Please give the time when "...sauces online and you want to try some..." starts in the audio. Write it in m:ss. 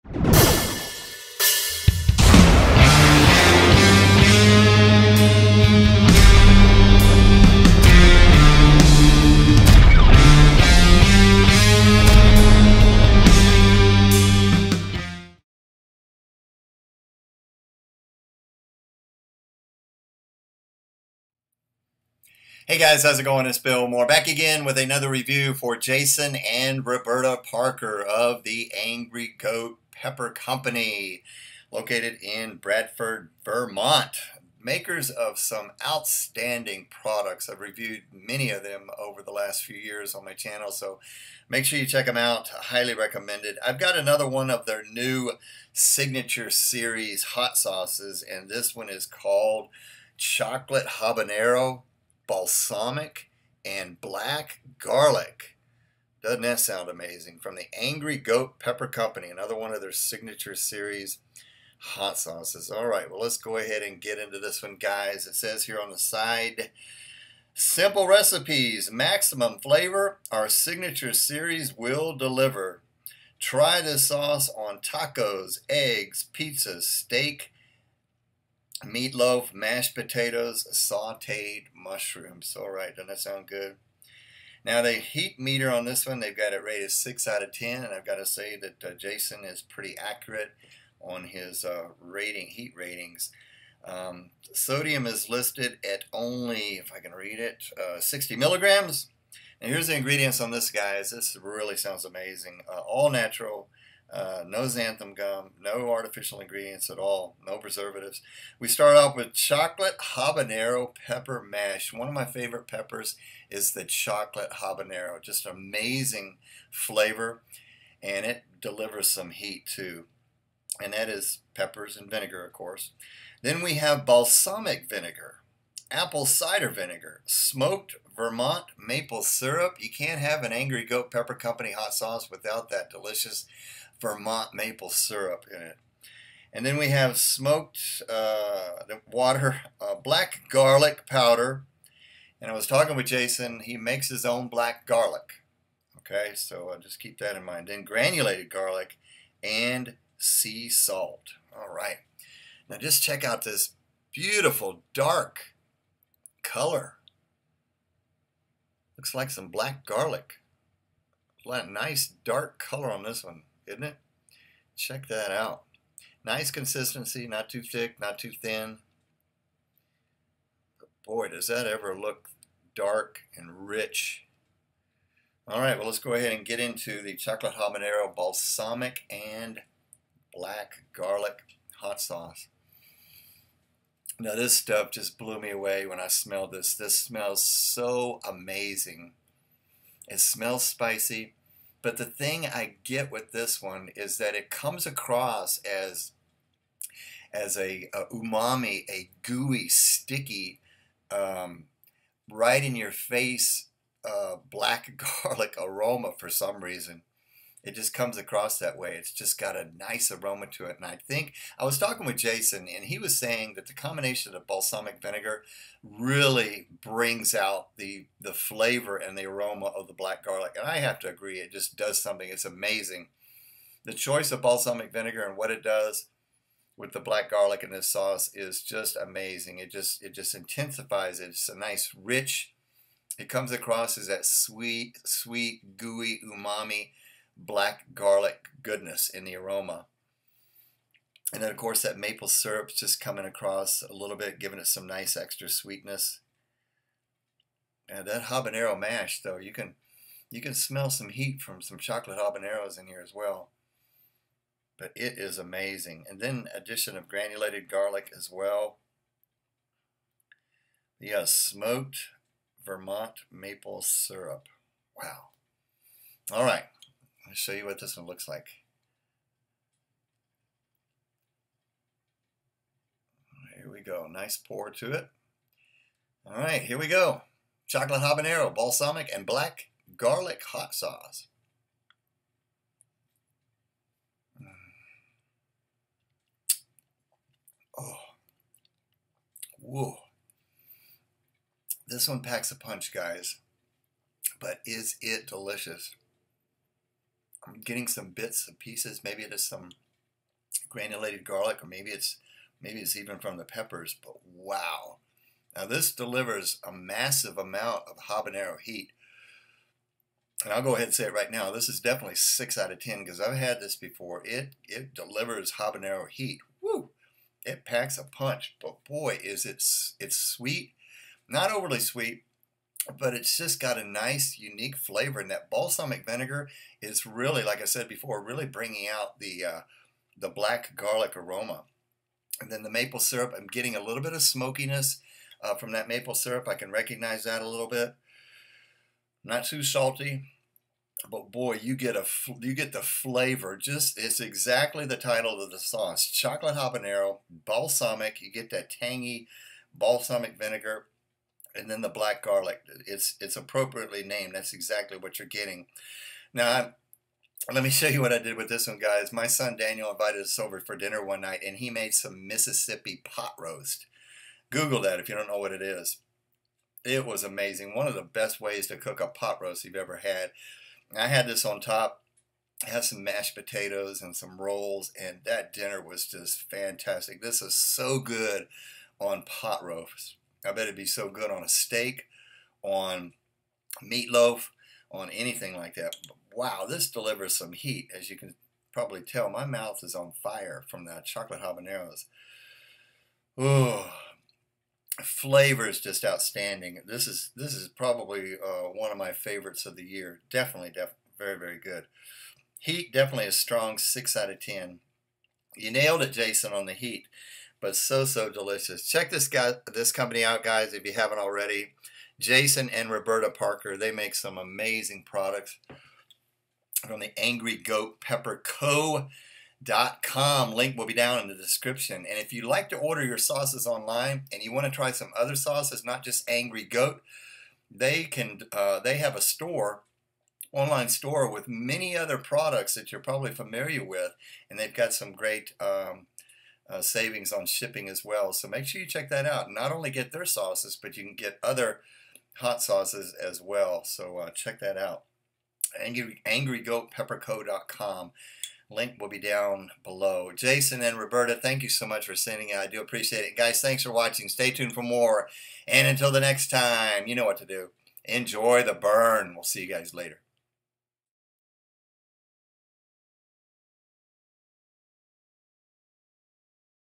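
7:03.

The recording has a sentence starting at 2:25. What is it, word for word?
Okay, so I'll just keep that in mind.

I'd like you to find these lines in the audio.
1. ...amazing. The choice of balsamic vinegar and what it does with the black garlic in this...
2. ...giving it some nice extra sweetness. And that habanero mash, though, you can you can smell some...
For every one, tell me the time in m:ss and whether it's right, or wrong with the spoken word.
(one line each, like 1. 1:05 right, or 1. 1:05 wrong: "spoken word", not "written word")
1. 3:42 right
2. 4:04 right.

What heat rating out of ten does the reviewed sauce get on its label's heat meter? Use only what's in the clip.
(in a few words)
6 out of 10.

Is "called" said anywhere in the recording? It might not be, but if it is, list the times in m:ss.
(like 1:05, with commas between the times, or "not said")
0:49.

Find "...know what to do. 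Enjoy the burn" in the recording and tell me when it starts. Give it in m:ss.
7:37.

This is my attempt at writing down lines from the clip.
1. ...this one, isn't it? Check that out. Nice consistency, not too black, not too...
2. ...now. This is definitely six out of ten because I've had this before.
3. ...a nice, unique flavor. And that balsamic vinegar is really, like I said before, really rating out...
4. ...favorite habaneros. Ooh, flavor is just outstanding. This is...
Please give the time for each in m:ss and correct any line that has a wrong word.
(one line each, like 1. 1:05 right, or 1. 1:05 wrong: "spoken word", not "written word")
1. 2:43 wrong: "thick", not "black"
2. 5:11 right
3. 5:23 wrong: "bringing", not "rating"
4. 6:31 wrong: "chocolate", not "favorite".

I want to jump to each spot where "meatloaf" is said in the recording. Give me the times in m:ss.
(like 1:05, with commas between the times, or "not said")
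1:18, 6:23.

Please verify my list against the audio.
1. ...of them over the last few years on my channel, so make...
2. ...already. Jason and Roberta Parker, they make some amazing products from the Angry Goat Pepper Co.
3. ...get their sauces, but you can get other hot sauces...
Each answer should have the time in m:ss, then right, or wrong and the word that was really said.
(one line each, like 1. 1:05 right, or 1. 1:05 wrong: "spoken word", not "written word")
1. 0:38 right
2. 6:51 right
3. 7:19 right.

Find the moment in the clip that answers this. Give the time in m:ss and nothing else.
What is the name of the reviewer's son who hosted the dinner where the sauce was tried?
5:59.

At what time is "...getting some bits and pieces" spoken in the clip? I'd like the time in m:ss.
4:57.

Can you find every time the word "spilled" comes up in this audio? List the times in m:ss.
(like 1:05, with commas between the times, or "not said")
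not said.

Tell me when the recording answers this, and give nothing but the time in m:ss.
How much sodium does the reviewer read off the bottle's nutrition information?
1:37.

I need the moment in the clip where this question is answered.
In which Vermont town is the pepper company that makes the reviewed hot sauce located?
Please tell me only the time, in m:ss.
0:32.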